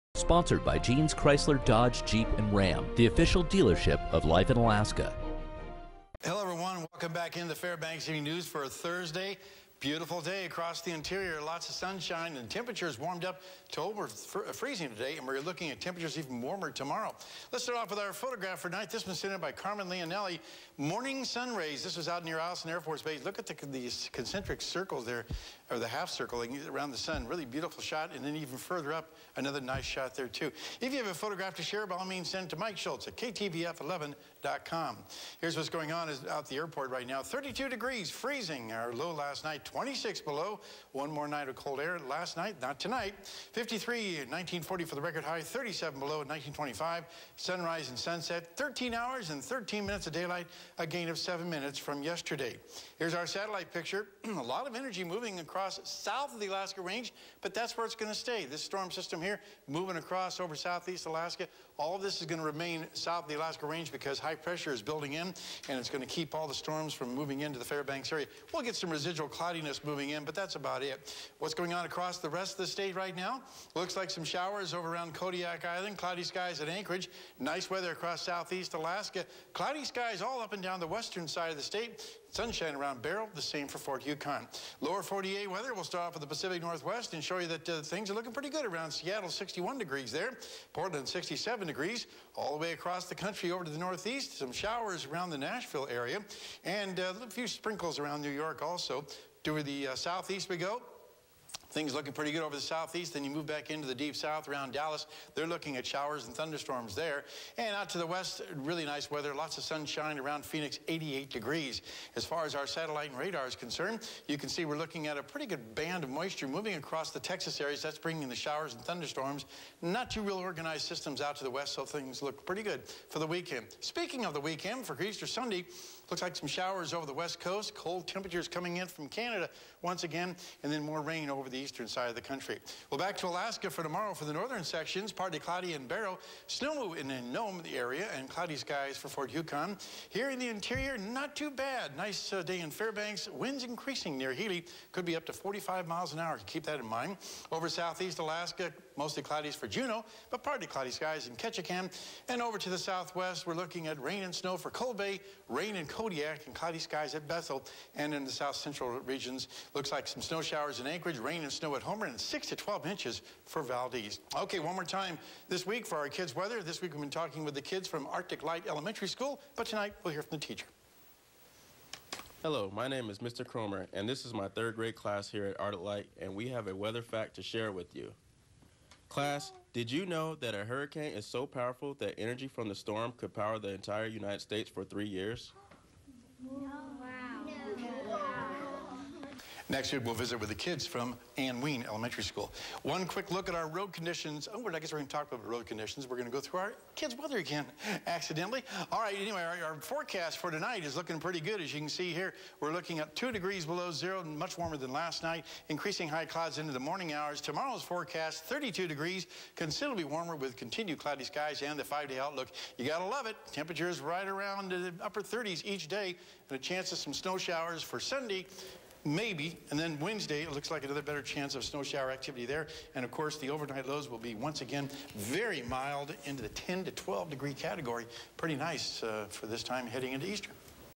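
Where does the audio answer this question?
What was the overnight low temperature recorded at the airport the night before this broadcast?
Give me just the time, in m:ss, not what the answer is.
0:39.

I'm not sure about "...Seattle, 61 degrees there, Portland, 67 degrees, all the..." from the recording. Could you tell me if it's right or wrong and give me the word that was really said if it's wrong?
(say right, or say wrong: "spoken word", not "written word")
right.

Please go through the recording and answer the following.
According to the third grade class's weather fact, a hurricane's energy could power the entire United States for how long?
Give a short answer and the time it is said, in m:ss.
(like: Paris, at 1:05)
3 years, at 3:04.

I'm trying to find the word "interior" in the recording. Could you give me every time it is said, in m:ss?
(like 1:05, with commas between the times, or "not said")
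0:10, 2:20.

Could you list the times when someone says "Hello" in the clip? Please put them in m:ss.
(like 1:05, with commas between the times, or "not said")
0:06, 2:52.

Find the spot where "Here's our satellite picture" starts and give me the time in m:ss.
0:52.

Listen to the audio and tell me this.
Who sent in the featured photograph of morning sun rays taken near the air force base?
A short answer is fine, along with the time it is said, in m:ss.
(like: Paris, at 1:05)
Carmen Leonelli, at 0:19.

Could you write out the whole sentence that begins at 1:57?
That's bringing the showers and thunderstorms.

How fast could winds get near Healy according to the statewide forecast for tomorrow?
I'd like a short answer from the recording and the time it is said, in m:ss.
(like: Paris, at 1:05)
45 miles an hour, at 2:25.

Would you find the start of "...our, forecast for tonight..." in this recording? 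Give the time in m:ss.
3:19.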